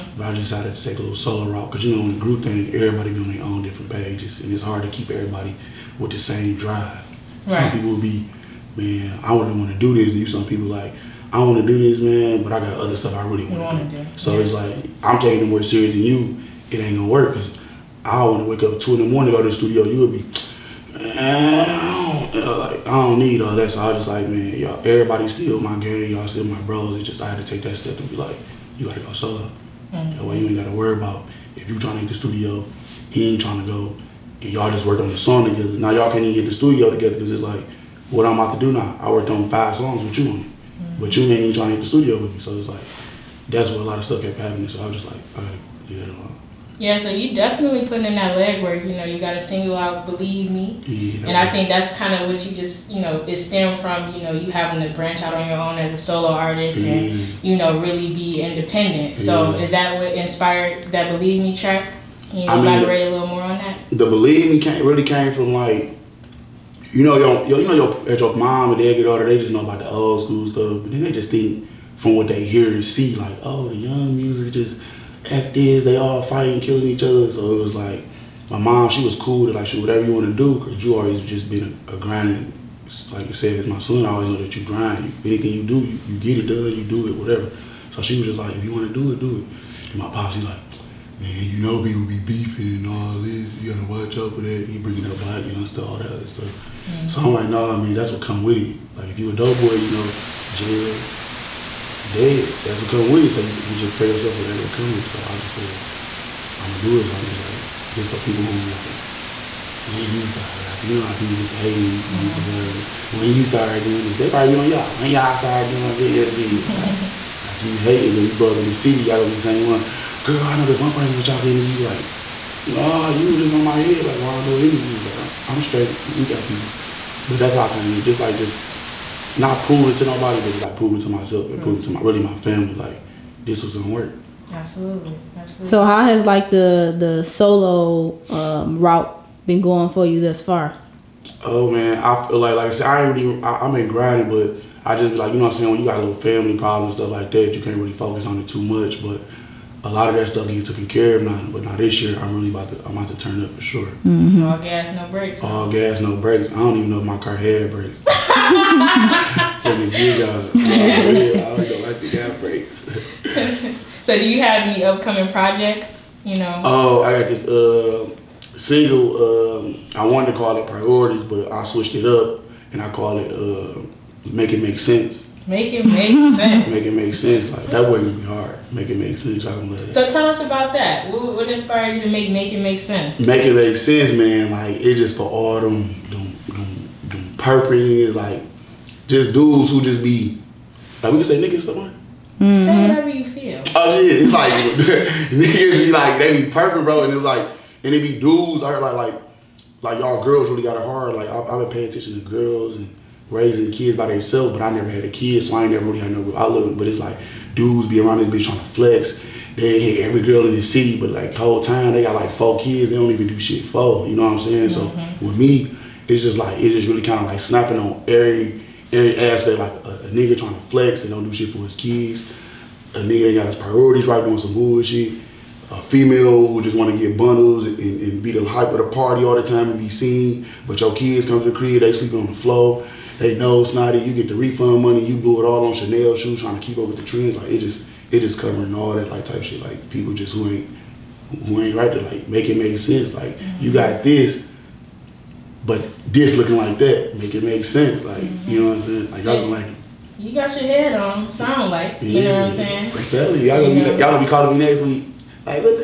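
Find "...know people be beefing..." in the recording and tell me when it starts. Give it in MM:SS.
01:31.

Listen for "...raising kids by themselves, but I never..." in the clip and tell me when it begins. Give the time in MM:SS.
03:23.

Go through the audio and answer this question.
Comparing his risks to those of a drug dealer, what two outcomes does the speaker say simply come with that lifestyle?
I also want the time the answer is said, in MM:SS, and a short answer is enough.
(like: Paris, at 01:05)
jail, dead, at 01:40.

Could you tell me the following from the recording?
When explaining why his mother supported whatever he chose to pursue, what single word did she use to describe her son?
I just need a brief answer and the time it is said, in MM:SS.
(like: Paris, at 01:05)
grinder, at 01:21.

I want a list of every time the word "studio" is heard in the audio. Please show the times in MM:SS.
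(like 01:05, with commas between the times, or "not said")
00:19, 00:32, 00:36, 00:41.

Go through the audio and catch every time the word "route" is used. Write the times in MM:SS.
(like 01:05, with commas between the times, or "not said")
00:01, 02:18.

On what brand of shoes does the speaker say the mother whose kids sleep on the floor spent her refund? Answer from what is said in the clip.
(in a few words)
Chanel.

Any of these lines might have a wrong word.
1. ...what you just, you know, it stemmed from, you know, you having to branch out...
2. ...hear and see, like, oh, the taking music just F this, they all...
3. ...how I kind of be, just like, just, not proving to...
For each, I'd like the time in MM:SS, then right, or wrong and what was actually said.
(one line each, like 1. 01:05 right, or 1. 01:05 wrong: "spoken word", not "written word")
1. 00:52 right
2. 01:12 wrong: "young", not "taking"
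3. 02:07 right.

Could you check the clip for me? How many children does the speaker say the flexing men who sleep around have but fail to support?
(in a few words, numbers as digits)
4.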